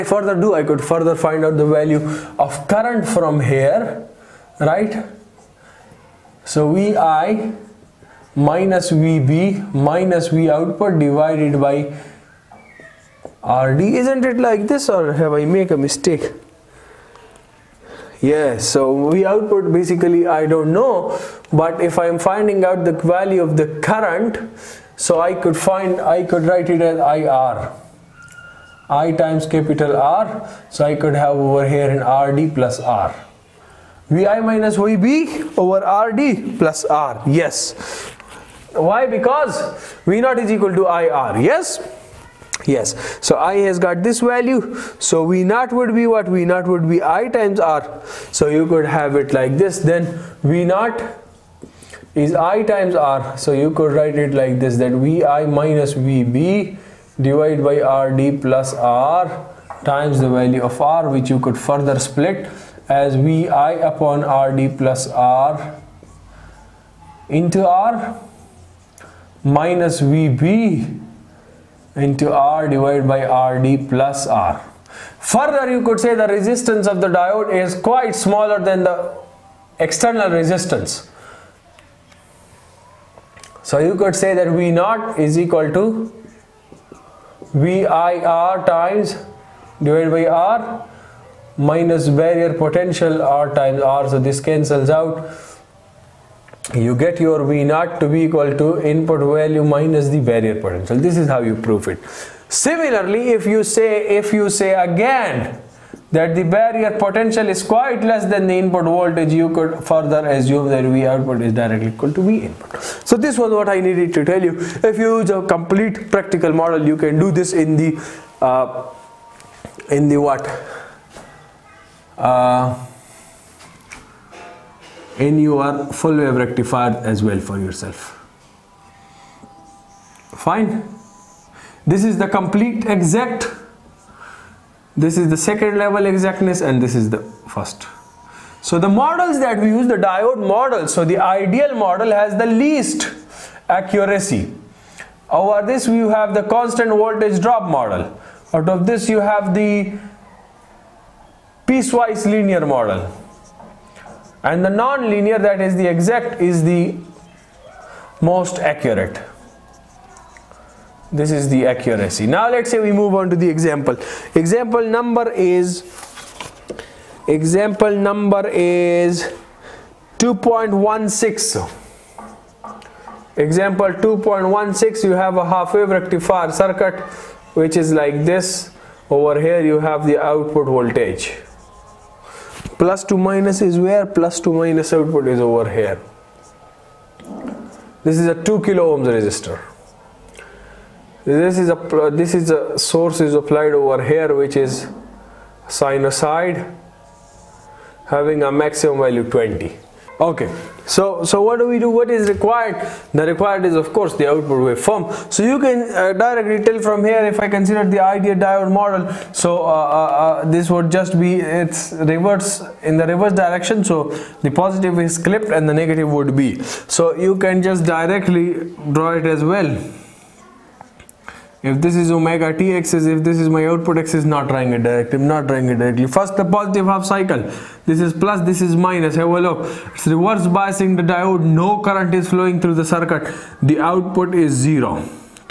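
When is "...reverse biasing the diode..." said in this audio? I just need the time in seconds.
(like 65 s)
230 s.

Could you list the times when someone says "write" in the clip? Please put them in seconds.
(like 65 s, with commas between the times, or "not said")
26 s, 53 s.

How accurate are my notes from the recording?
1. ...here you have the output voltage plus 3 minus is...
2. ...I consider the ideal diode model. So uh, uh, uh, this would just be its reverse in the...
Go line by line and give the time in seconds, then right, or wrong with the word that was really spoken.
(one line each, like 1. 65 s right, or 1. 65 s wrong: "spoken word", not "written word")
1. 179 s wrong: "2", not "3"
2. 207 s right.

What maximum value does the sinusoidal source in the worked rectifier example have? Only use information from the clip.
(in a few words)
20.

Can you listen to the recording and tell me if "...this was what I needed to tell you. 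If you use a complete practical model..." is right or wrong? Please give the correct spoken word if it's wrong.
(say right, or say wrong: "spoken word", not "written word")
right.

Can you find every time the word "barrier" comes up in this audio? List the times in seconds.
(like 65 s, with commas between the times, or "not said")
92 s, 100 s, 106 s.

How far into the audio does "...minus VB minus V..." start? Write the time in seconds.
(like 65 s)
8 s.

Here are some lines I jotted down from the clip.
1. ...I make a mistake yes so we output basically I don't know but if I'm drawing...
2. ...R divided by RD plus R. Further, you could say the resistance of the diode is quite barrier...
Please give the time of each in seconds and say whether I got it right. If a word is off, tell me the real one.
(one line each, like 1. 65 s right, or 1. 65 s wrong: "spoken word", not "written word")
1. 15 s wrong: "finding", not "drawing"
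2. 72 s wrong: "smaller", not "barrier".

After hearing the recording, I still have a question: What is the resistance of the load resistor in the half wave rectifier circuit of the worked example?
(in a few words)
2 kilo ohms.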